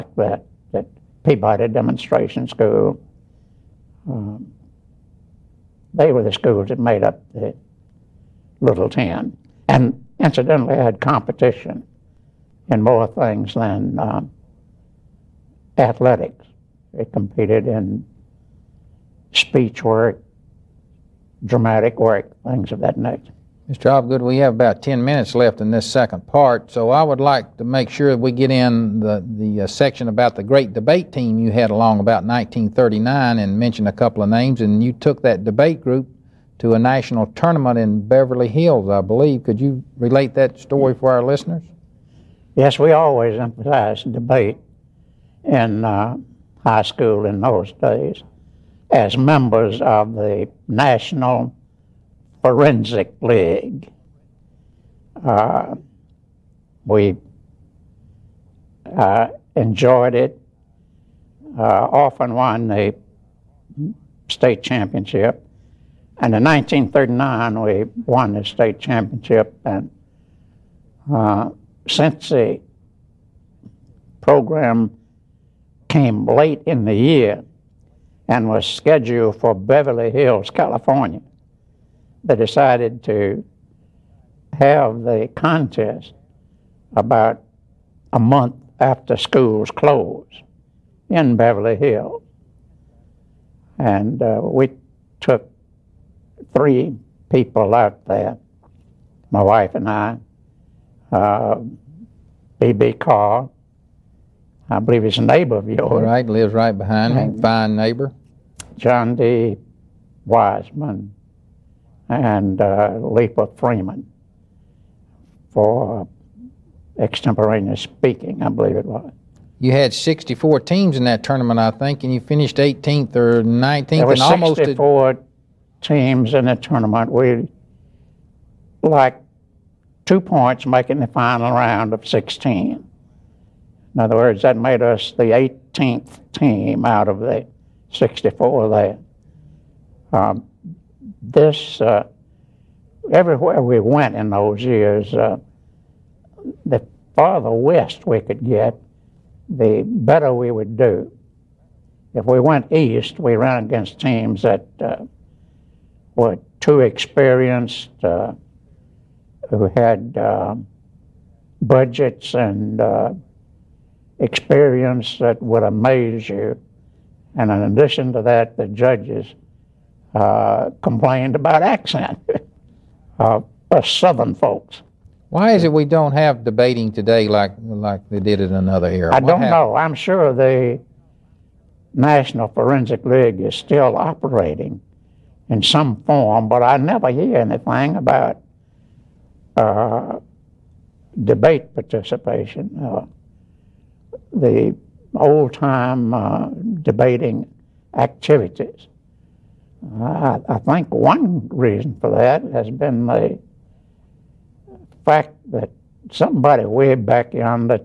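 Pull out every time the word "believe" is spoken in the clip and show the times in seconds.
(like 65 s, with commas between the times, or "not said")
39 s, 104 s, 118 s.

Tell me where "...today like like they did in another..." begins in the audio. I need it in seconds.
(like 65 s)
176 s.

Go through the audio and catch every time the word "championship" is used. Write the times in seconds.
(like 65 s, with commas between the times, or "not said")
64 s, 68 s.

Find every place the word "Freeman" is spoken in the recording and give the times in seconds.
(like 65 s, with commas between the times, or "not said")
113 s.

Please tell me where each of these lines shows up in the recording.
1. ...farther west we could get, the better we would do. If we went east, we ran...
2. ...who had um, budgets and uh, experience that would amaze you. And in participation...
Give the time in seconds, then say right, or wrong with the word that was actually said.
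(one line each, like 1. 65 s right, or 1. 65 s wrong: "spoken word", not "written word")
1. 147 s right
2. 159 s wrong: "addition", not "participation".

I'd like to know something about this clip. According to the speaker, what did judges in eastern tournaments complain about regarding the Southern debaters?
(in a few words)
accent.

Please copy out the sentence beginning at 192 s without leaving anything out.
Uh, the old time uh, debating activities.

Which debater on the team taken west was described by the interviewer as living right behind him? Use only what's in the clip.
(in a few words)
B.B. Carr.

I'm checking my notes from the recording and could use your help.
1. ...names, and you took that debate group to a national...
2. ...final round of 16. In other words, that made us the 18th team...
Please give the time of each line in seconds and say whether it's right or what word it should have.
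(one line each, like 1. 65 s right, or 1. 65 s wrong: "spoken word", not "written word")
1. 34 s right
2. 131 s right.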